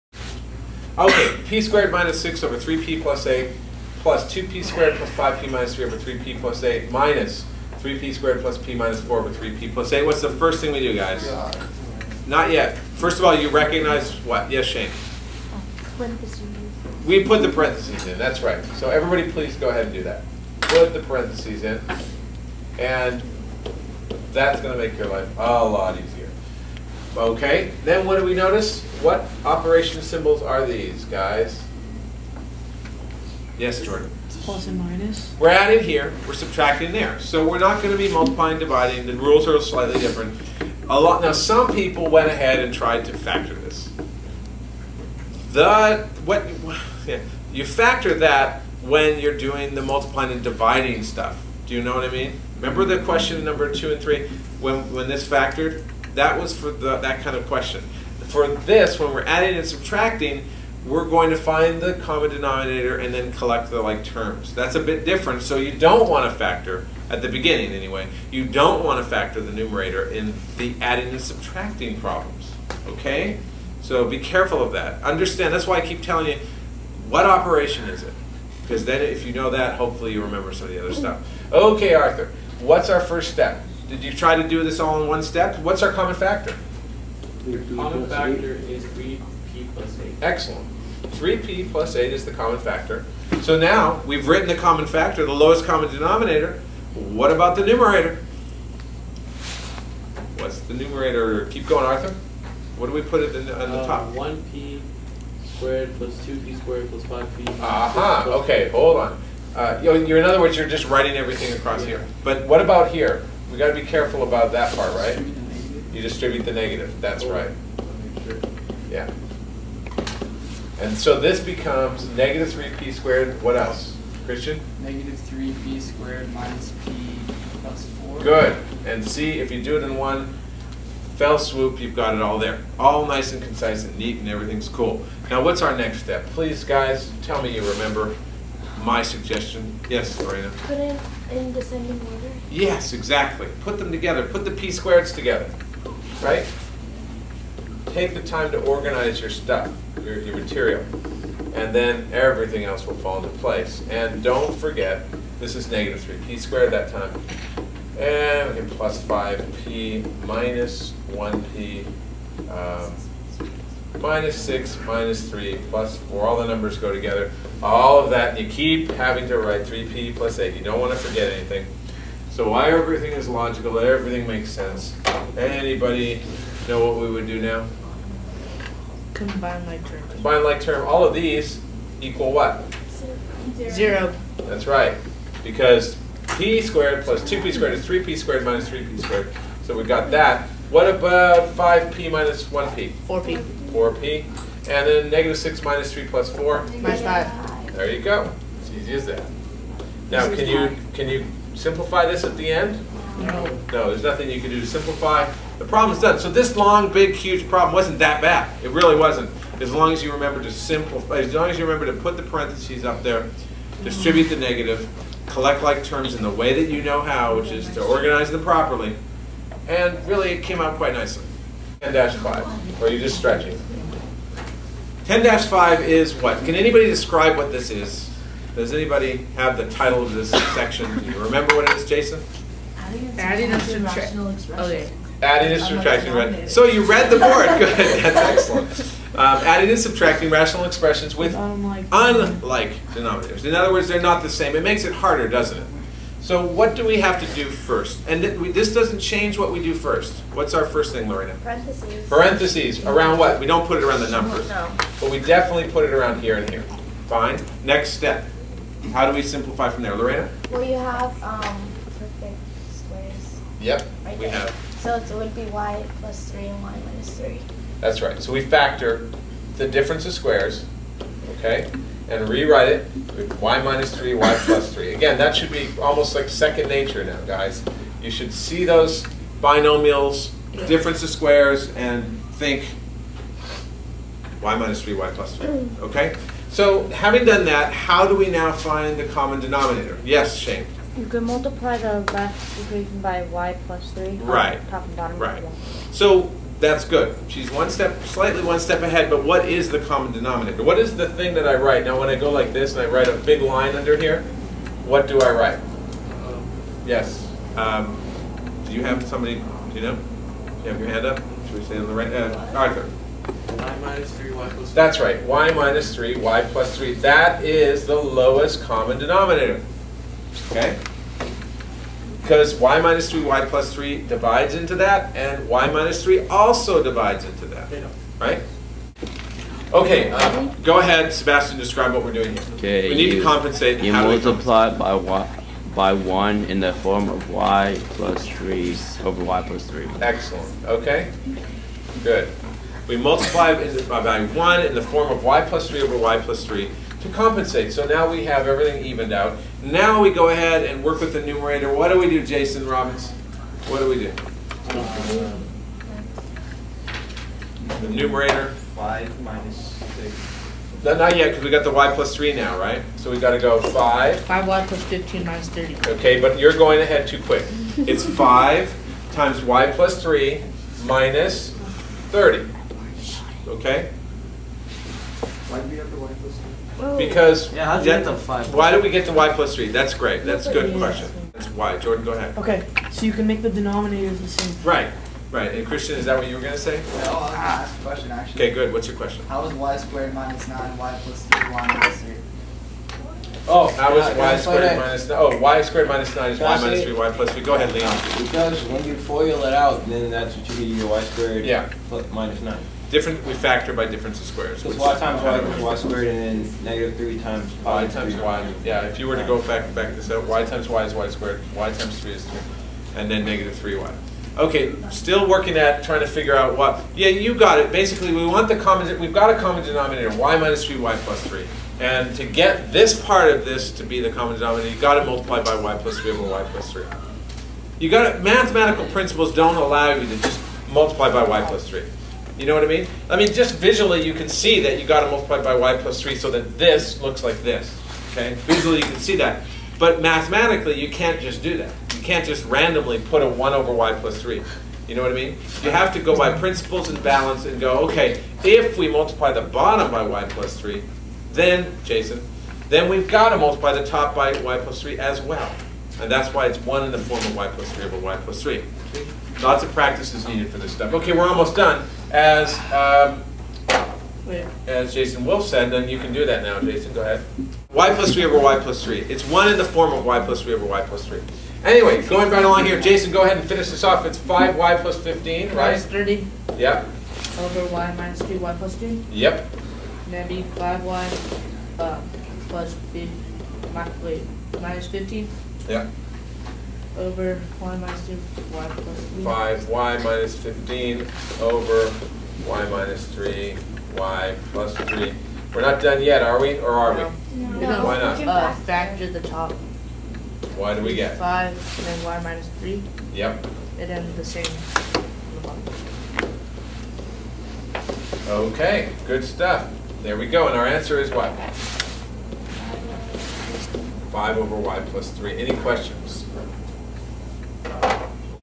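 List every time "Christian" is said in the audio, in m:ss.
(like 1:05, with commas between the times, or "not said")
2:04, 6:25.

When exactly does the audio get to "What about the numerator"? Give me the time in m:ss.
1:36.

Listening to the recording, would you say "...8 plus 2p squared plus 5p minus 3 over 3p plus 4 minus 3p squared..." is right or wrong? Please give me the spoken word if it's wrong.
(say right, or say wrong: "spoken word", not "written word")
wrong: "8", not "4".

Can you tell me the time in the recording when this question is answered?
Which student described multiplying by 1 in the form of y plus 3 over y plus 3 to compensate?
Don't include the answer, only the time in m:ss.
5:30.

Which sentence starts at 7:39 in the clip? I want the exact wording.
Lots of practice is needed for this stuff.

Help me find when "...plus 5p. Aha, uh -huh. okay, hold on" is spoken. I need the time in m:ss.
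1:46.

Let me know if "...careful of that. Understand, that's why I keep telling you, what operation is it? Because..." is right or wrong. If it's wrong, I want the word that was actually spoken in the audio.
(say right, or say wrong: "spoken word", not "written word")
right.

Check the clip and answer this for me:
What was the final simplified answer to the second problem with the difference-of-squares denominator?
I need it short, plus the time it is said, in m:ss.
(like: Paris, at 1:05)
5/(y + 3), at 8:34.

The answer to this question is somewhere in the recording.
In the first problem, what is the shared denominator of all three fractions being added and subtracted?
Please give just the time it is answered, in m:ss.
1:31.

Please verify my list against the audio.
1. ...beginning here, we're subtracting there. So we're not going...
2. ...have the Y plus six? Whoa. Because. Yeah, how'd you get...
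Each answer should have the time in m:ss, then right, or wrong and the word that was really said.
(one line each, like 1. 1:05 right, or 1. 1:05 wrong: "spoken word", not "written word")
1. 0:35 wrong: "adding", not "beginning"
2. 6:15 wrong: "three", not "six".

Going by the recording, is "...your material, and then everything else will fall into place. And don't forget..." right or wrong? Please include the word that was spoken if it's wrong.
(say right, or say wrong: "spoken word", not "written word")
right.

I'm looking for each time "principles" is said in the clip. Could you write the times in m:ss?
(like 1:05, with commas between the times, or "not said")
7:08, 7:26.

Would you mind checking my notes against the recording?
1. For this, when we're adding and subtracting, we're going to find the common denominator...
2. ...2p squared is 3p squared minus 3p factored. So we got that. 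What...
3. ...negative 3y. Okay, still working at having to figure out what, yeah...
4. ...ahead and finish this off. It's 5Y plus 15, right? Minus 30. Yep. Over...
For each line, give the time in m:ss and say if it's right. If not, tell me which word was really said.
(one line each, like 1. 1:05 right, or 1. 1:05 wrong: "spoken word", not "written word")
1. 0:58 right
2. 3:07 wrong: "squared", not "factored"
3. 6:53 wrong: "trying", not "having"
4. 7:53 right.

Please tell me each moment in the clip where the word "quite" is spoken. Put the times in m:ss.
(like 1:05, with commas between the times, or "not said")
3:40.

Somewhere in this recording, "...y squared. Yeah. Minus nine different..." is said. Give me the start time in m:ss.
6:40.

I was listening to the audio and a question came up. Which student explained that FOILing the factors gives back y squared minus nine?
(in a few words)
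Leon.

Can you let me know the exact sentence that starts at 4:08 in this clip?
And th we, this doesn't change what we do first.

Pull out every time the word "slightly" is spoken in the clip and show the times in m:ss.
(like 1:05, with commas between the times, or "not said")
0:39, 4:58.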